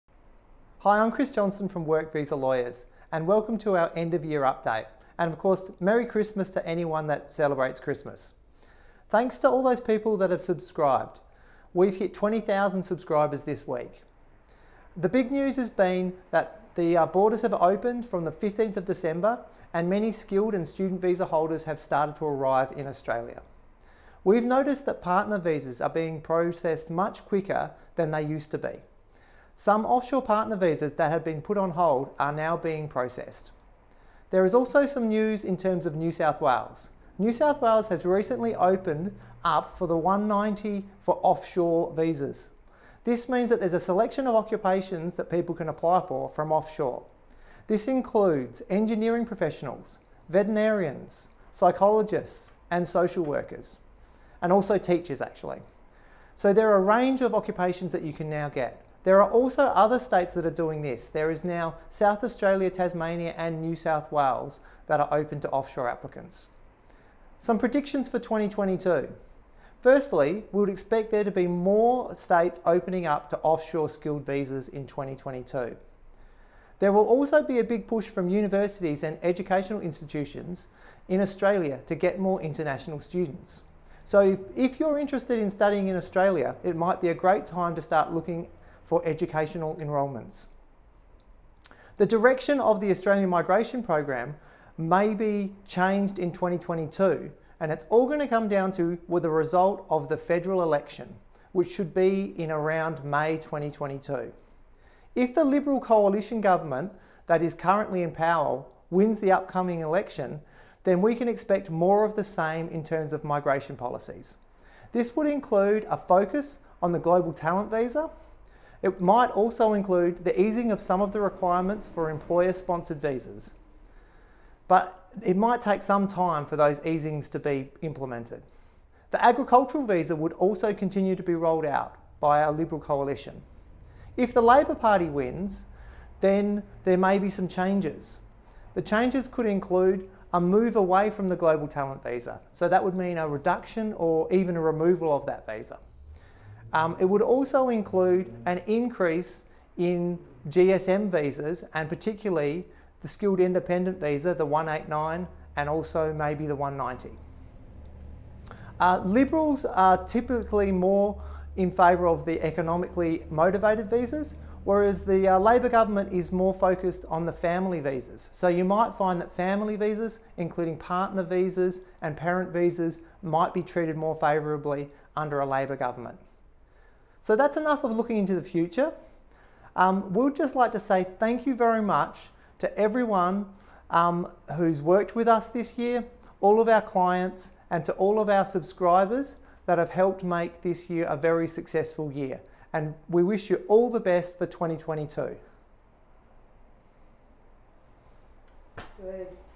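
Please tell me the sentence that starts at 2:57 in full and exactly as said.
So that's enough of looking into the future.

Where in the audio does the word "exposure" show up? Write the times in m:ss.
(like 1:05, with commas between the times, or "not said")
not said.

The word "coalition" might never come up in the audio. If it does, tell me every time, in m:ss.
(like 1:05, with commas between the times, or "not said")
1:45, 2:12.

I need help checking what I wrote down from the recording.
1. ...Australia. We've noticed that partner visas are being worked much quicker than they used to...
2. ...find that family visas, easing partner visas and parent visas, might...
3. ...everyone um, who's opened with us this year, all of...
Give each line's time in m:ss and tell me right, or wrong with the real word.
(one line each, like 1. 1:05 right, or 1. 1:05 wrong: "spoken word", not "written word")
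1. 0:22 wrong: "processed", not "worked"
2. 2:48 wrong: "including", not "easing"
3. 3:02 wrong: "worked", not "opened".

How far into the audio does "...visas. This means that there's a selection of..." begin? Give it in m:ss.
0:41.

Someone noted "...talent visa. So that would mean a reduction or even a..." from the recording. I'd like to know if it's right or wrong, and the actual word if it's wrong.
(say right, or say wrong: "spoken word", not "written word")
right.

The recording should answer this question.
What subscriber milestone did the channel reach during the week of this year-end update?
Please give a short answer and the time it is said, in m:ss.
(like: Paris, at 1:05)
20,000, at 0:12.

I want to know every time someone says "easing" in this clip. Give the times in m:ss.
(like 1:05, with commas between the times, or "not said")
2:00, 2:06.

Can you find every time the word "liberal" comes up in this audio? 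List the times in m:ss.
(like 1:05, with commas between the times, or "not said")
1:45, 2:12, 2:39.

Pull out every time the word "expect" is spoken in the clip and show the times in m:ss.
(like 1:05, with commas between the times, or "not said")
1:10, 1:51.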